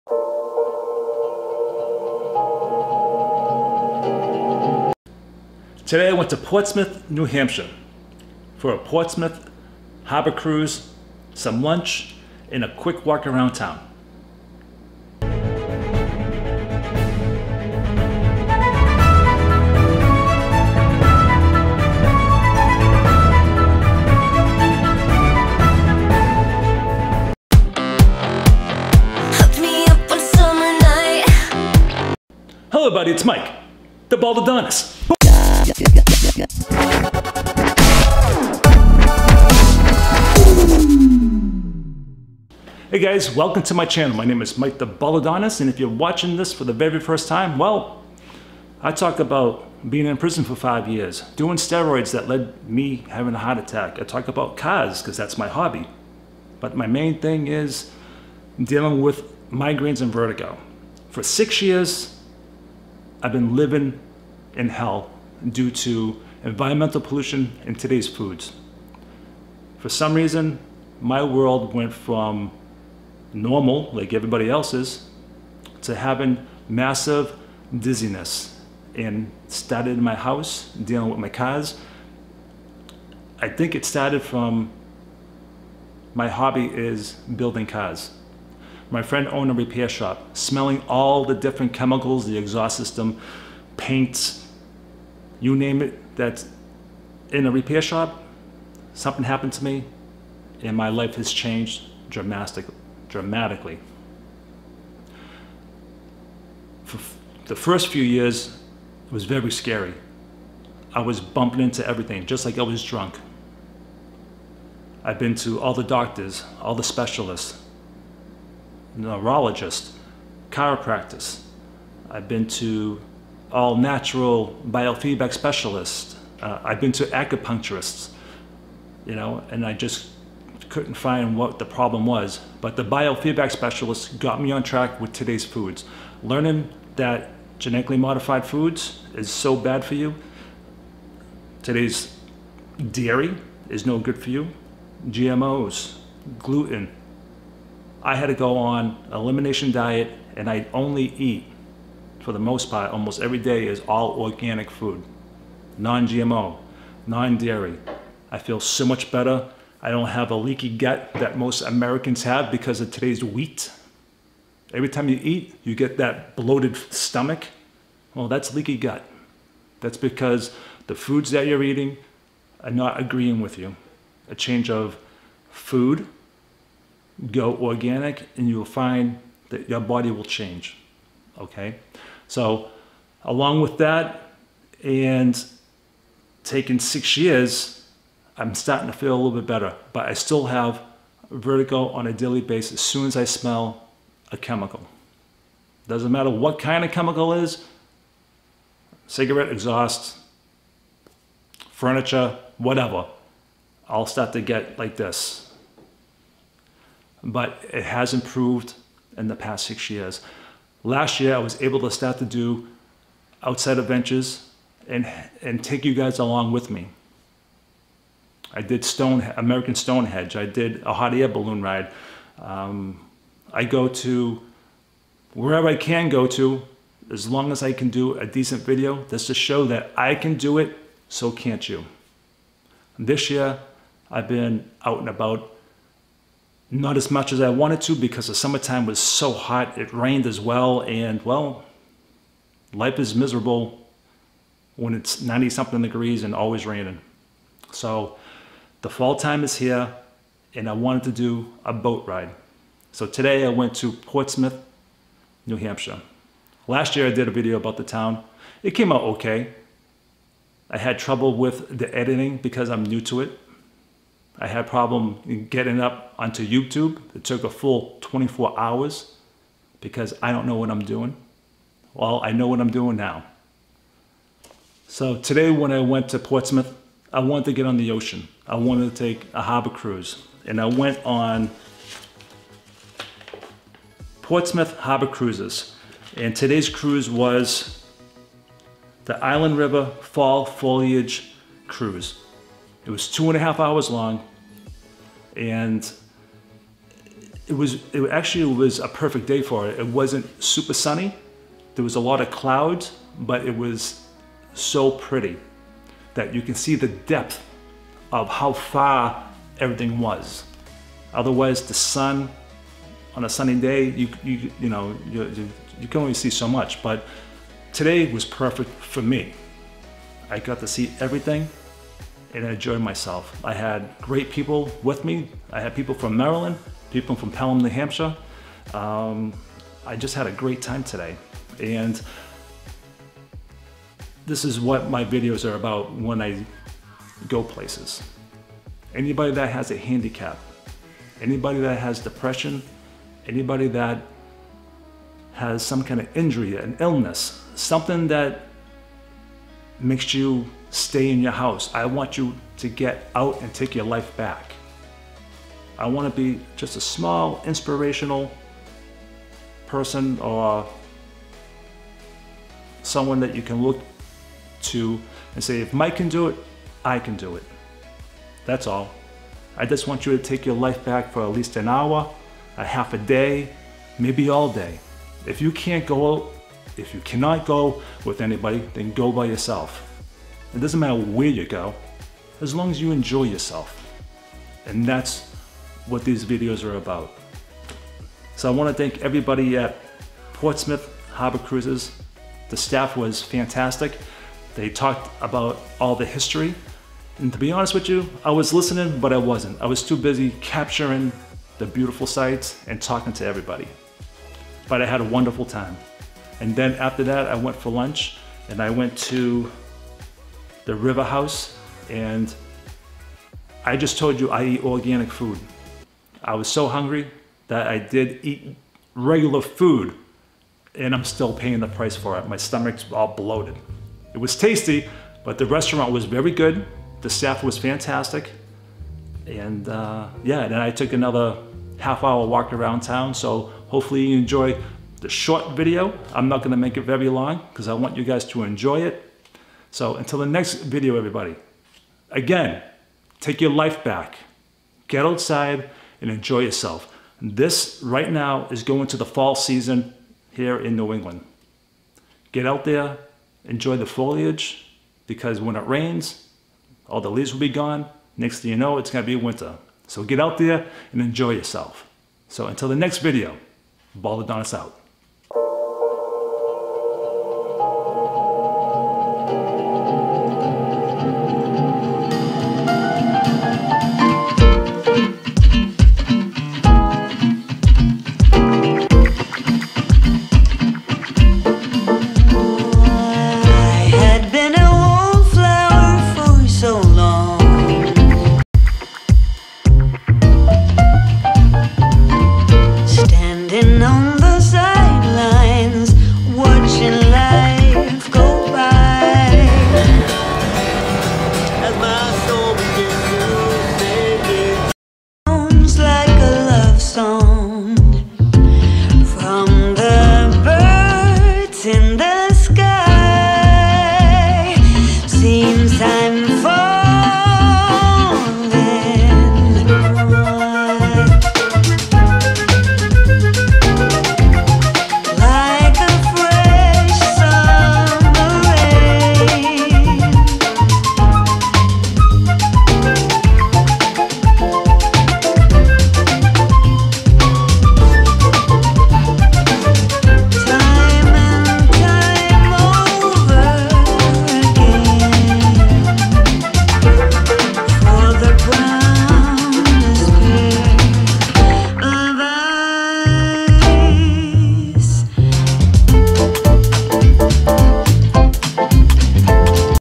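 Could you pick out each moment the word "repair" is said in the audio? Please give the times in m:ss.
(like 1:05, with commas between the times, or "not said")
1:29, 1:37.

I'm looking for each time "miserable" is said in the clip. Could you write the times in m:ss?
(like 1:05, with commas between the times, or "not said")
4:03.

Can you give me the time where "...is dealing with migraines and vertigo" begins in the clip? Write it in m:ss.
0:57.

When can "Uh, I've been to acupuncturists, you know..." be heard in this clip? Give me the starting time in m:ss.
2:06.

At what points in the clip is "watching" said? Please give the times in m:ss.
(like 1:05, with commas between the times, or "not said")
0:45.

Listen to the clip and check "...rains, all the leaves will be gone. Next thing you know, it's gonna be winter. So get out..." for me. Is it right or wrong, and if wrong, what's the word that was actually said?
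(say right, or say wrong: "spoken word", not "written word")
right.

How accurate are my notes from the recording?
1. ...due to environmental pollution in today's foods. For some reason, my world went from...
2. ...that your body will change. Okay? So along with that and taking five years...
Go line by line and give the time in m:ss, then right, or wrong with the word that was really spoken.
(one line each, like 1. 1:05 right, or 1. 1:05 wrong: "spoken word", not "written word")
1. 1:05 right
2. 2:59 wrong: "six", not "five".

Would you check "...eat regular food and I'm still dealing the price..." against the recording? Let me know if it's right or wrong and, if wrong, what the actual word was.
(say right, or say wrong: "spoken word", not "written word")
wrong: "paying", not "dealing".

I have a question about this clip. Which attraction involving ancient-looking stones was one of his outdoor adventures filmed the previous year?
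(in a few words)
American Stonehenge.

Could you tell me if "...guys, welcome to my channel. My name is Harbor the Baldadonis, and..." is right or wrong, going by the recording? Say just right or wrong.
wrong.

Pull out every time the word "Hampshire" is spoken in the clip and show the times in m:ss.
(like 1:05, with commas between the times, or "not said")
0:07, 4:15, 5:27.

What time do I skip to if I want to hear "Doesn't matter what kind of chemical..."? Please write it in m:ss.
3:15.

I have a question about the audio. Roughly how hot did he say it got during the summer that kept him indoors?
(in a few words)
90 something degrees.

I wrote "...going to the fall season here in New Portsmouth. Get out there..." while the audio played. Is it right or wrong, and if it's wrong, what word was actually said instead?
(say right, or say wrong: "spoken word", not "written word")
wrong: "England", not "Portsmouth".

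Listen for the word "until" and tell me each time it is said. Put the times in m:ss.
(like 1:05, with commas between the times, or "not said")
7:19, 7:42.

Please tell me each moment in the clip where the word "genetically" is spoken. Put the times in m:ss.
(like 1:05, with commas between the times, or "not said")
2:17.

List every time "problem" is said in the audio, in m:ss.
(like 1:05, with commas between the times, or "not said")
2:11, 4:24.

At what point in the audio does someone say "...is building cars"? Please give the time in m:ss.
1:26.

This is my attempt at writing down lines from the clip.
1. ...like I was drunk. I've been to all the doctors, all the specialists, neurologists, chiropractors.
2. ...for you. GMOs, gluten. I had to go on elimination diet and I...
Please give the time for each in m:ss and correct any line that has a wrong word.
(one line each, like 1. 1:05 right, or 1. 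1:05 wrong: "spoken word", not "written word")
1. 1:52 right
2. 2:24 right.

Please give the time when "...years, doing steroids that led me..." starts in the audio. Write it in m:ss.
0:50.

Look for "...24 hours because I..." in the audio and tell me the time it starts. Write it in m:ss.
4:28.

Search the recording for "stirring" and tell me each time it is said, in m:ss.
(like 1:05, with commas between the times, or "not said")
not said.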